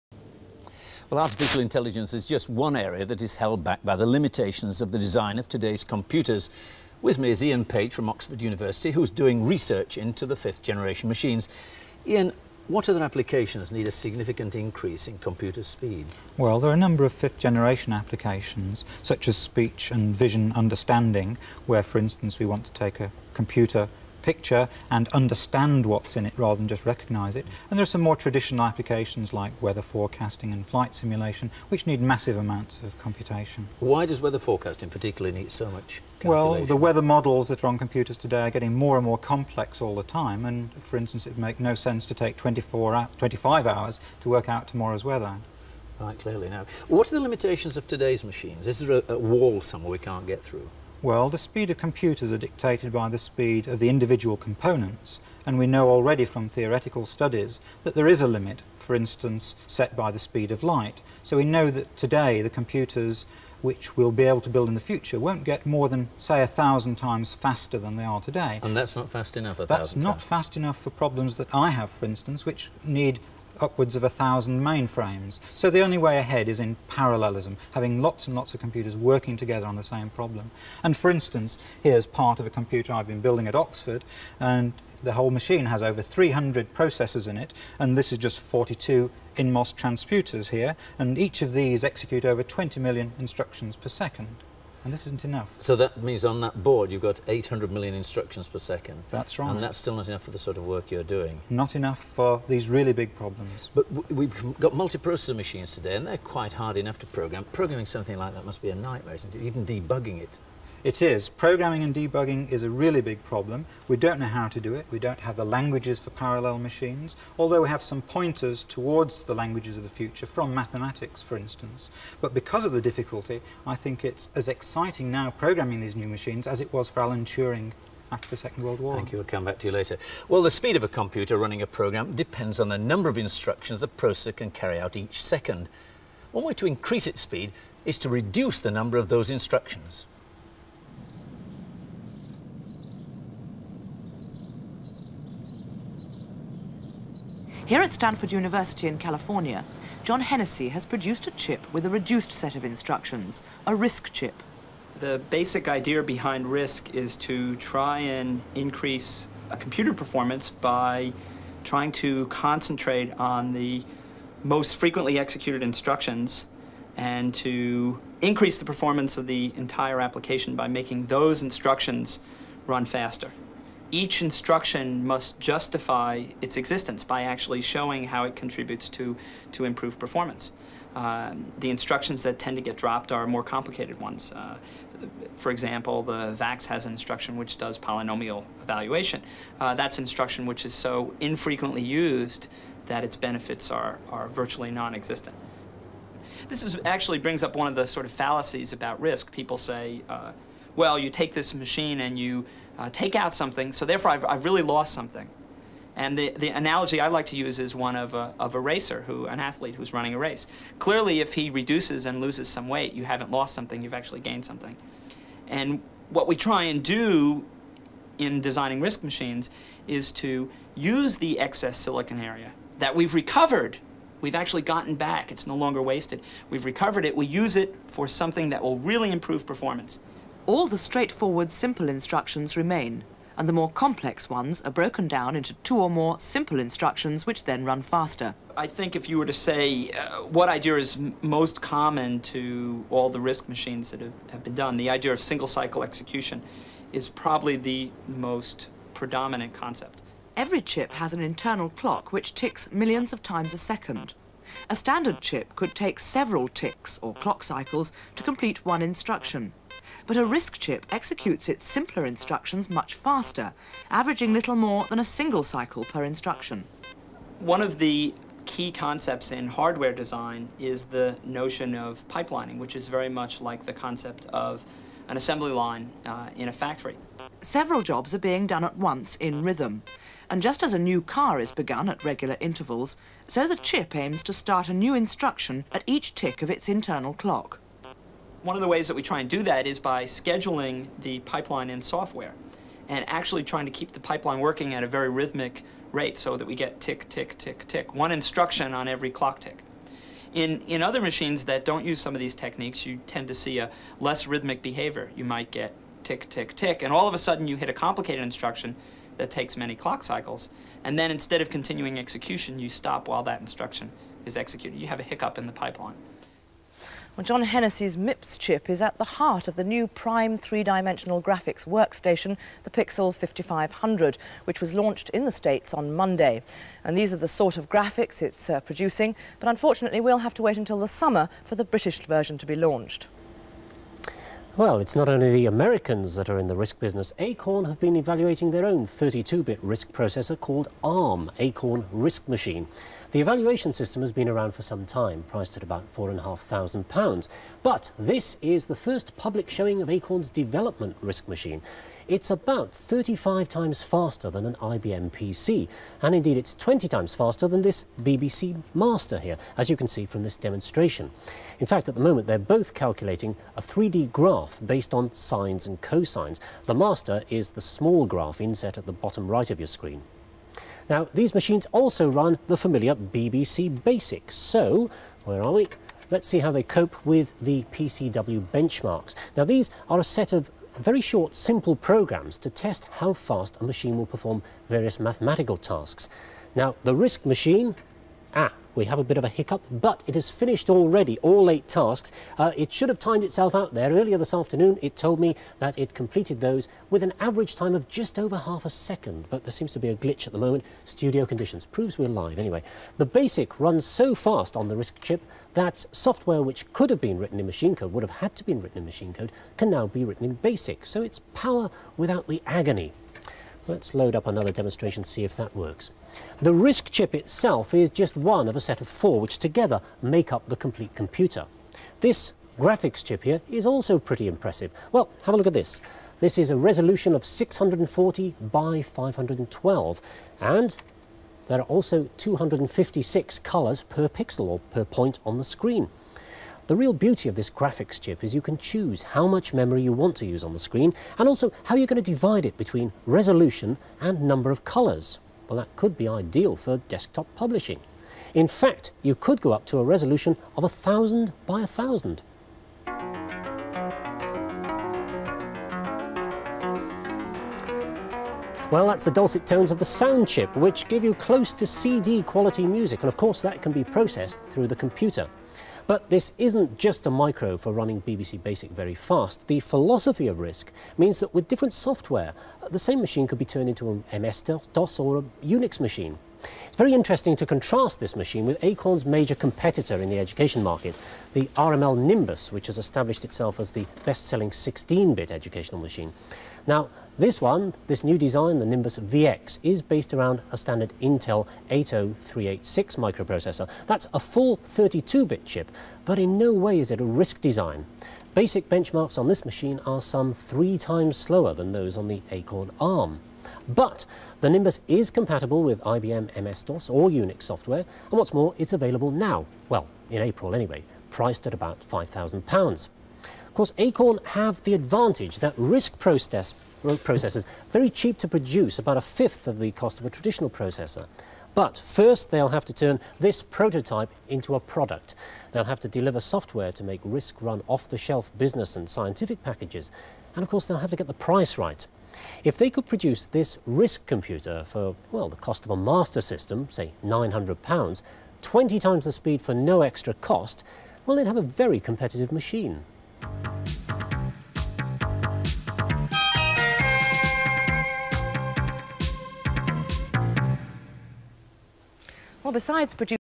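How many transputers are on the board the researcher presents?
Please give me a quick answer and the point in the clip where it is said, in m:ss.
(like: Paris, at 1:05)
42, at 1:28.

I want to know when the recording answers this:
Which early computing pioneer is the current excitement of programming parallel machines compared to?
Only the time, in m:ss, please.
2:07.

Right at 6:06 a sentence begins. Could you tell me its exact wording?
The Master is the small graph inset at the bottom right of your screen.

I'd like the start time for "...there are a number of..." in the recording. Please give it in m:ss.
0:16.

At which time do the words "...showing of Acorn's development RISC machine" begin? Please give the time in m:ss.
5:49.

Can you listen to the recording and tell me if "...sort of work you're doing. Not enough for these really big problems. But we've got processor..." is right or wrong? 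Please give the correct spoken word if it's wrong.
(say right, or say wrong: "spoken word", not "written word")
wrong: "multiprocessor", not "processor".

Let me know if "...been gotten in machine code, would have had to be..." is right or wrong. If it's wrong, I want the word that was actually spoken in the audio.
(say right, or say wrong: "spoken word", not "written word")
wrong: "written", not "gotten".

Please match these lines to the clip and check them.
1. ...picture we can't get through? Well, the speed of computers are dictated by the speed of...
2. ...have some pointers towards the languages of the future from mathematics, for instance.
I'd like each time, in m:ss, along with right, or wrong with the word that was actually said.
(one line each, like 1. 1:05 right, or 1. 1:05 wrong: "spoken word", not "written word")
1. 0:49 wrong: "somewhere", not "picture"
2. 1:57 right.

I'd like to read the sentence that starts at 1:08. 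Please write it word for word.
And that's not fast enough, a that's thousand That's not times.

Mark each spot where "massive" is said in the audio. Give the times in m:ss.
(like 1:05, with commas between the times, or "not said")
0:32.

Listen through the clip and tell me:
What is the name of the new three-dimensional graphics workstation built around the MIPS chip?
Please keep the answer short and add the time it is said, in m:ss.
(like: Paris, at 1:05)
Pixel 5500, at 5:22.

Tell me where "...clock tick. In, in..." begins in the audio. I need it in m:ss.
4:59.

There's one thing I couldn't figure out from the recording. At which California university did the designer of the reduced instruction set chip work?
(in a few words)
Stanford University.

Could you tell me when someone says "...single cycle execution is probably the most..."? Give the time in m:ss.
4:05.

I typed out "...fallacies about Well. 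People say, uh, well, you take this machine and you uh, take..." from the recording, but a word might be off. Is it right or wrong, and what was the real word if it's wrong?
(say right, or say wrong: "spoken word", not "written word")
wrong: "RISC", not "Well".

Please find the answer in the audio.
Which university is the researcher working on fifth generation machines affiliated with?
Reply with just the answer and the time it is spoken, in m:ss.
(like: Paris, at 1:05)
Oxford University, at 0:08.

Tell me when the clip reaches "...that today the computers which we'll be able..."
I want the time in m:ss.
1:01.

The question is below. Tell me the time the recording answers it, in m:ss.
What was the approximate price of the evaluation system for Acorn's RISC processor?
5:45.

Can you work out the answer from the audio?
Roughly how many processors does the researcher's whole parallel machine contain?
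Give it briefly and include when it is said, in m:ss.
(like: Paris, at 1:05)
over 300, at 1:25.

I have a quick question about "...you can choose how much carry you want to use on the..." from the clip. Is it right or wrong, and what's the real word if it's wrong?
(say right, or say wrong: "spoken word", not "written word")
wrong: "memory", not "carry".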